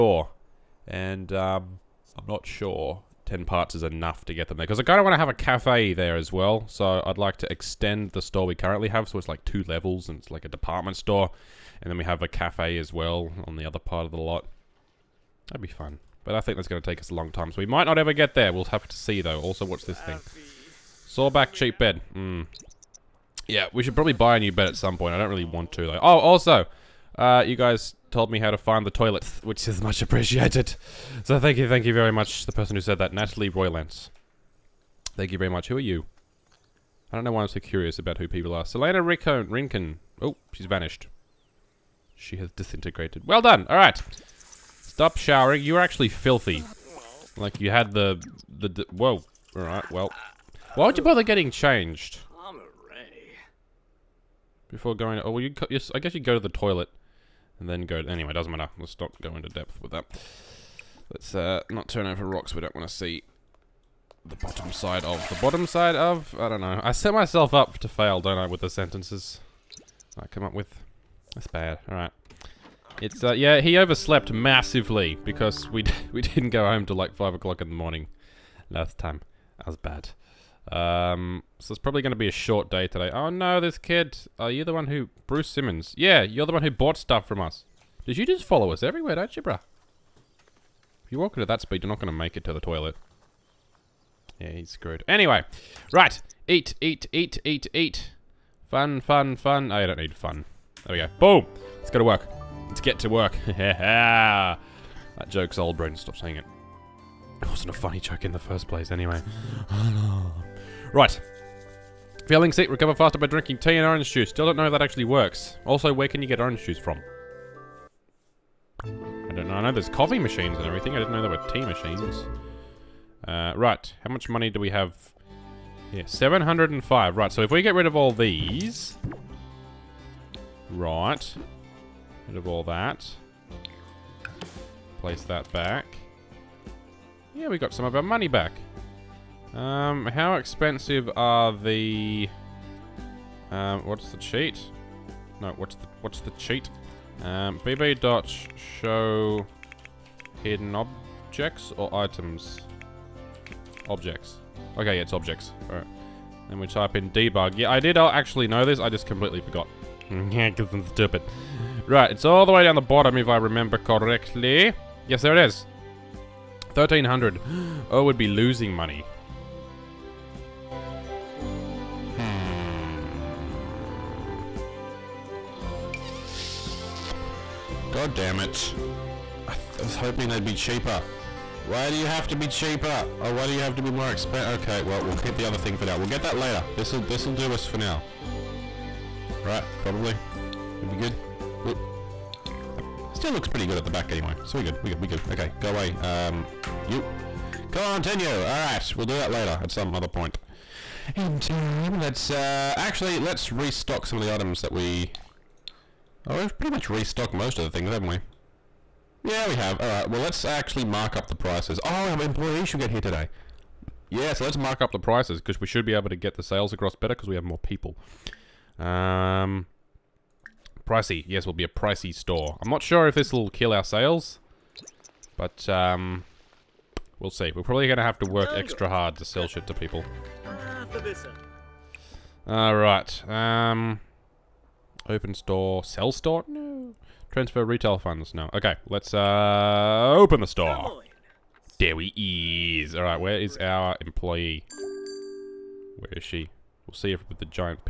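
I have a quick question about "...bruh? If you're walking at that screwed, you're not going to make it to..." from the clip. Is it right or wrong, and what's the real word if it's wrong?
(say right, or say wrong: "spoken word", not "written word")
wrong: "speed", not "screwed".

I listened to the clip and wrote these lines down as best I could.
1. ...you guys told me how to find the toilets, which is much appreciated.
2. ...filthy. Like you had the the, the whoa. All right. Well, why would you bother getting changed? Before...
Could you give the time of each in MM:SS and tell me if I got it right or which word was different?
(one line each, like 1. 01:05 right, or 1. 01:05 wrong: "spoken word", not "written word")
1. 00:27 right
2. 00:46 right.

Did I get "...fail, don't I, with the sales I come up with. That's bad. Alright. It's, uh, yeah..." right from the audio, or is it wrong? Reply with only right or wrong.
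wrong.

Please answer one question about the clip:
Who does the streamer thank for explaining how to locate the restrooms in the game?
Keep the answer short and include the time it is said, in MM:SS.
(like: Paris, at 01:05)
Natalie Roylance, at 00:33.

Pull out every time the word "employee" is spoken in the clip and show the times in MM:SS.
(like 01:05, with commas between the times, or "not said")
03:32, 04:04.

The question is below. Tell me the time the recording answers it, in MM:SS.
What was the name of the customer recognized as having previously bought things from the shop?
01:25.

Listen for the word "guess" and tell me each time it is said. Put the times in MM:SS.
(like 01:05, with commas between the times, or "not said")
00:55.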